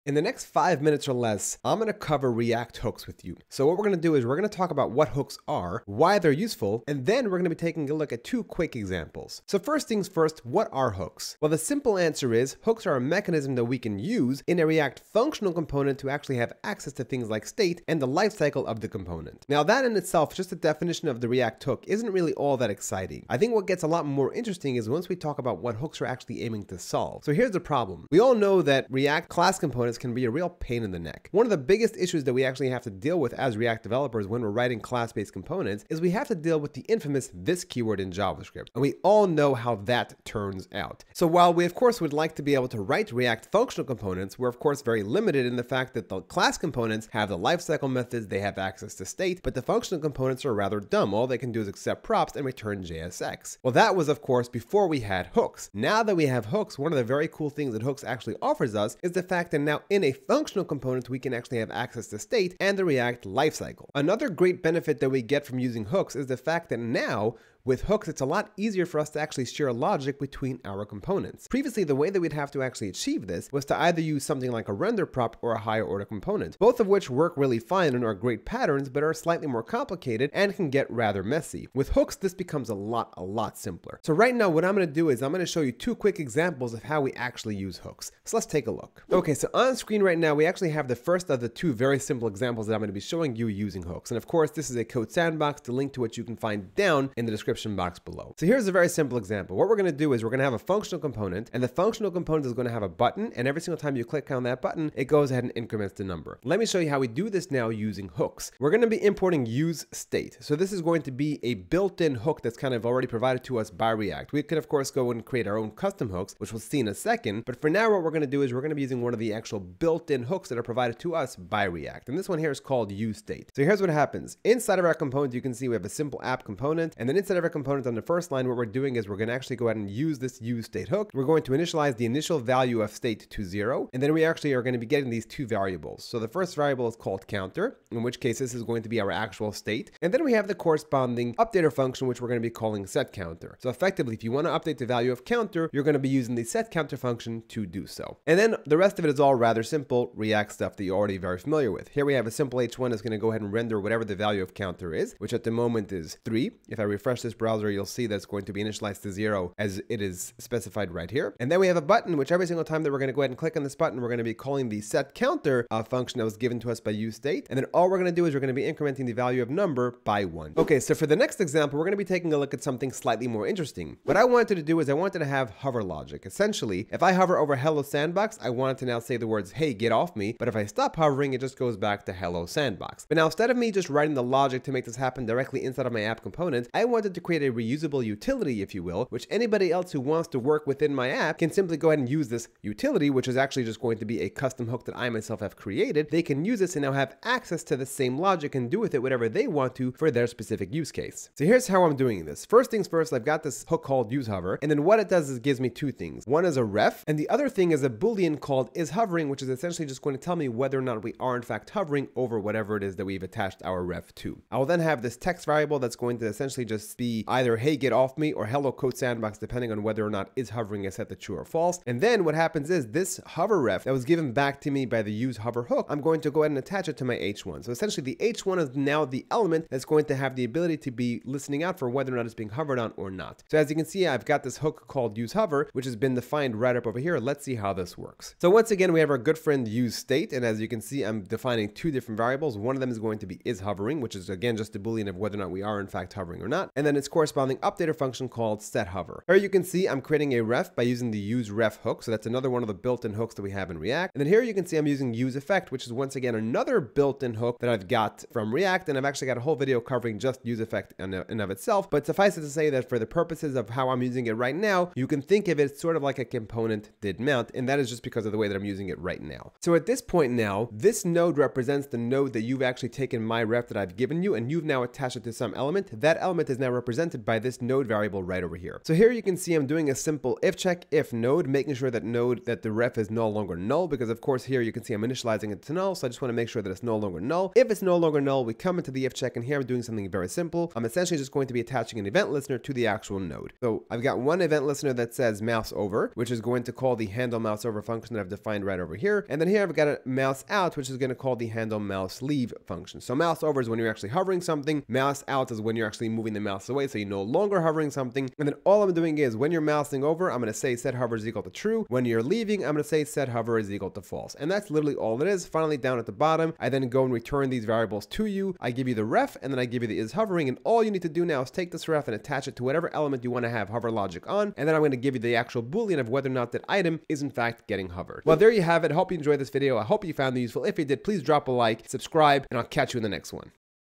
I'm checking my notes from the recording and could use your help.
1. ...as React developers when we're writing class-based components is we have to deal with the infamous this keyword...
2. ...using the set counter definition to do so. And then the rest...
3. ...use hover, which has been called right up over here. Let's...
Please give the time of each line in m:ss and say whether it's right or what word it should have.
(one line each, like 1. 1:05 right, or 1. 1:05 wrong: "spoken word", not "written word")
1. 0:33 right
2. 2:26 wrong: "function", not "definition"
3. 3:55 wrong: "defined", not "called".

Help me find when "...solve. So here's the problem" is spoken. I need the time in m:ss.
0:26.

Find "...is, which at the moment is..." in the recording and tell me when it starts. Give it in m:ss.
2:34.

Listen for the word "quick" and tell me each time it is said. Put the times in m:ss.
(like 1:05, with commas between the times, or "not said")
0:08, 1:25.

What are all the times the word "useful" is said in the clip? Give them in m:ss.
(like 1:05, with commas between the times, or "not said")
0:06, 5:30.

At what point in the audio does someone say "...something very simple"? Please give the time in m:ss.
4:49.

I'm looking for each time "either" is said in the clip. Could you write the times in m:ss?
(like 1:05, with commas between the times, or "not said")
1:13, 3:37.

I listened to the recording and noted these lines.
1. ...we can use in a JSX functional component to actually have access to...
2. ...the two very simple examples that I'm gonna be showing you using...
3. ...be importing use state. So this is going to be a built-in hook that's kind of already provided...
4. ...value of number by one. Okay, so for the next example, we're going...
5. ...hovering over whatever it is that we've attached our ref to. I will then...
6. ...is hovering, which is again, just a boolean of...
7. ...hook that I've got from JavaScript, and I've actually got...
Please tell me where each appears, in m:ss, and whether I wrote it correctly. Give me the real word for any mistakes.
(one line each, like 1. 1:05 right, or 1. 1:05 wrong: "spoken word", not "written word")
1. 0:13 wrong: "React", not "JSX"
2. 1:31 right
3. 1:48 right
4. 2:49 right
5. 3:31 right
6. 4:03 right
7. 4:17 wrong: "React", not "JavaScript".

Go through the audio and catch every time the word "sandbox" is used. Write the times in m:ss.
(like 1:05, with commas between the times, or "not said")
1:35, 2:57, 3:02, 3:38.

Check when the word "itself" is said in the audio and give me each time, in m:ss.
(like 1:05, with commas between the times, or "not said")
0:19, 4:21.